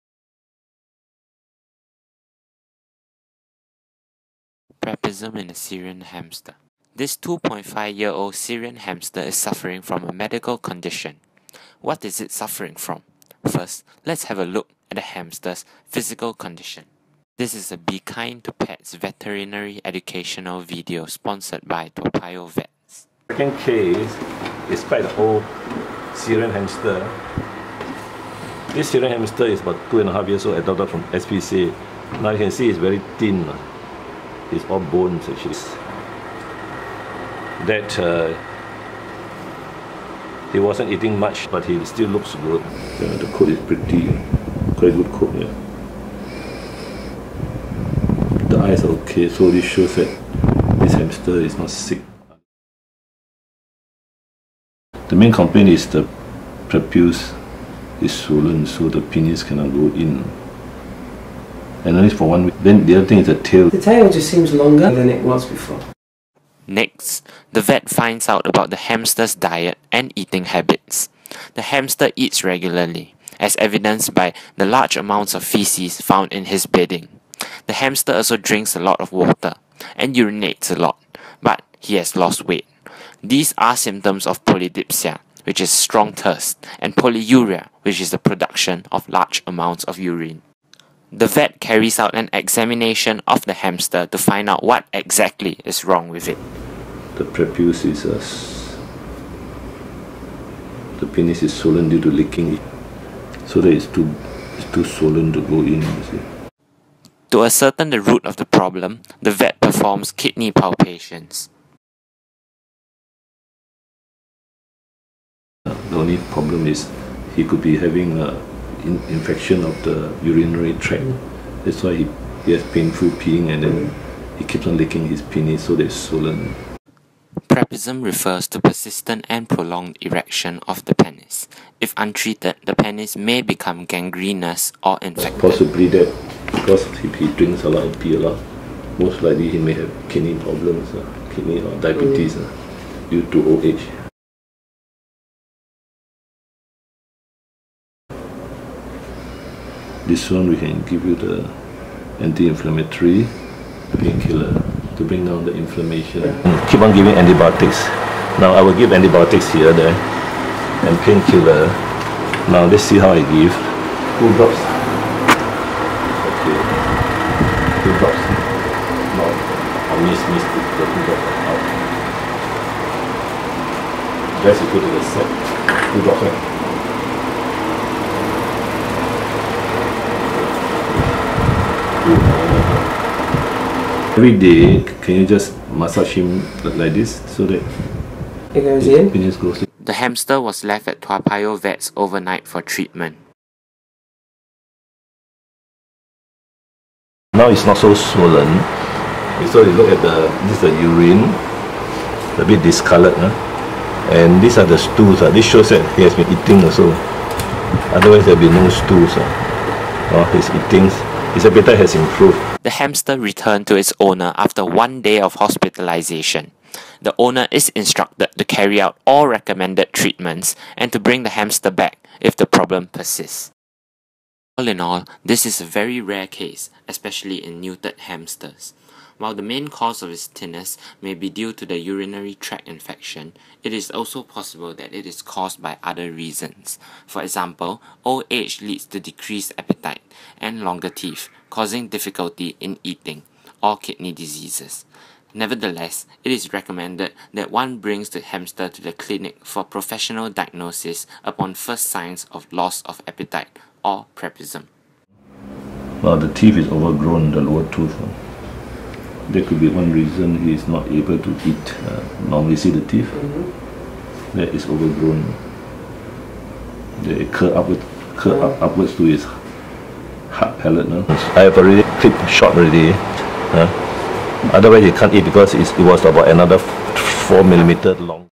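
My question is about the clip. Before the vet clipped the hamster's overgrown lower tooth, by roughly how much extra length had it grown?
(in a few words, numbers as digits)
4 millimeters.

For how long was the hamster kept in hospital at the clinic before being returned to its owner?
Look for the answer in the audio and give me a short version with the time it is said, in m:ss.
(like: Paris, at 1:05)
1 day, at 3:34.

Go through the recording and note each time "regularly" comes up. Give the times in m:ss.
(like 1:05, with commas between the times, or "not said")
1:12.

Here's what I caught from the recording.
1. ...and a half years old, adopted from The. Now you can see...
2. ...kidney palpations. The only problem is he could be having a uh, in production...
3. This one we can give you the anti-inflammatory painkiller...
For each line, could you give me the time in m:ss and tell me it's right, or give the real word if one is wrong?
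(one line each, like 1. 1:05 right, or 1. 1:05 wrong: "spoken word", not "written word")
1. 0:30 wrong: "SPCA", not "The"
2. 1:50 wrong: "infection", not "production"
3. 2:30 right.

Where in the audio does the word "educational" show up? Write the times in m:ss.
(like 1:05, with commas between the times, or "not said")
0:19.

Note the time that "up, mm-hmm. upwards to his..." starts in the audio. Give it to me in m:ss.
4:28.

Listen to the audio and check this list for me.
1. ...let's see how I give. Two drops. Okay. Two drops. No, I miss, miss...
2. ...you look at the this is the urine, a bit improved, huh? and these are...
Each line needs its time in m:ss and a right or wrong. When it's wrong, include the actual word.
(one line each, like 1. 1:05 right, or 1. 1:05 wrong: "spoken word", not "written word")
1. 2:42 right
2. 3:19 wrong: "discolored", not "improved".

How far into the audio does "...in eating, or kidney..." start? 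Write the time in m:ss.
4:02.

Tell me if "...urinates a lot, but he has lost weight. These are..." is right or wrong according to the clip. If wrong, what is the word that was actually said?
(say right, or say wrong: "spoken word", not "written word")
right.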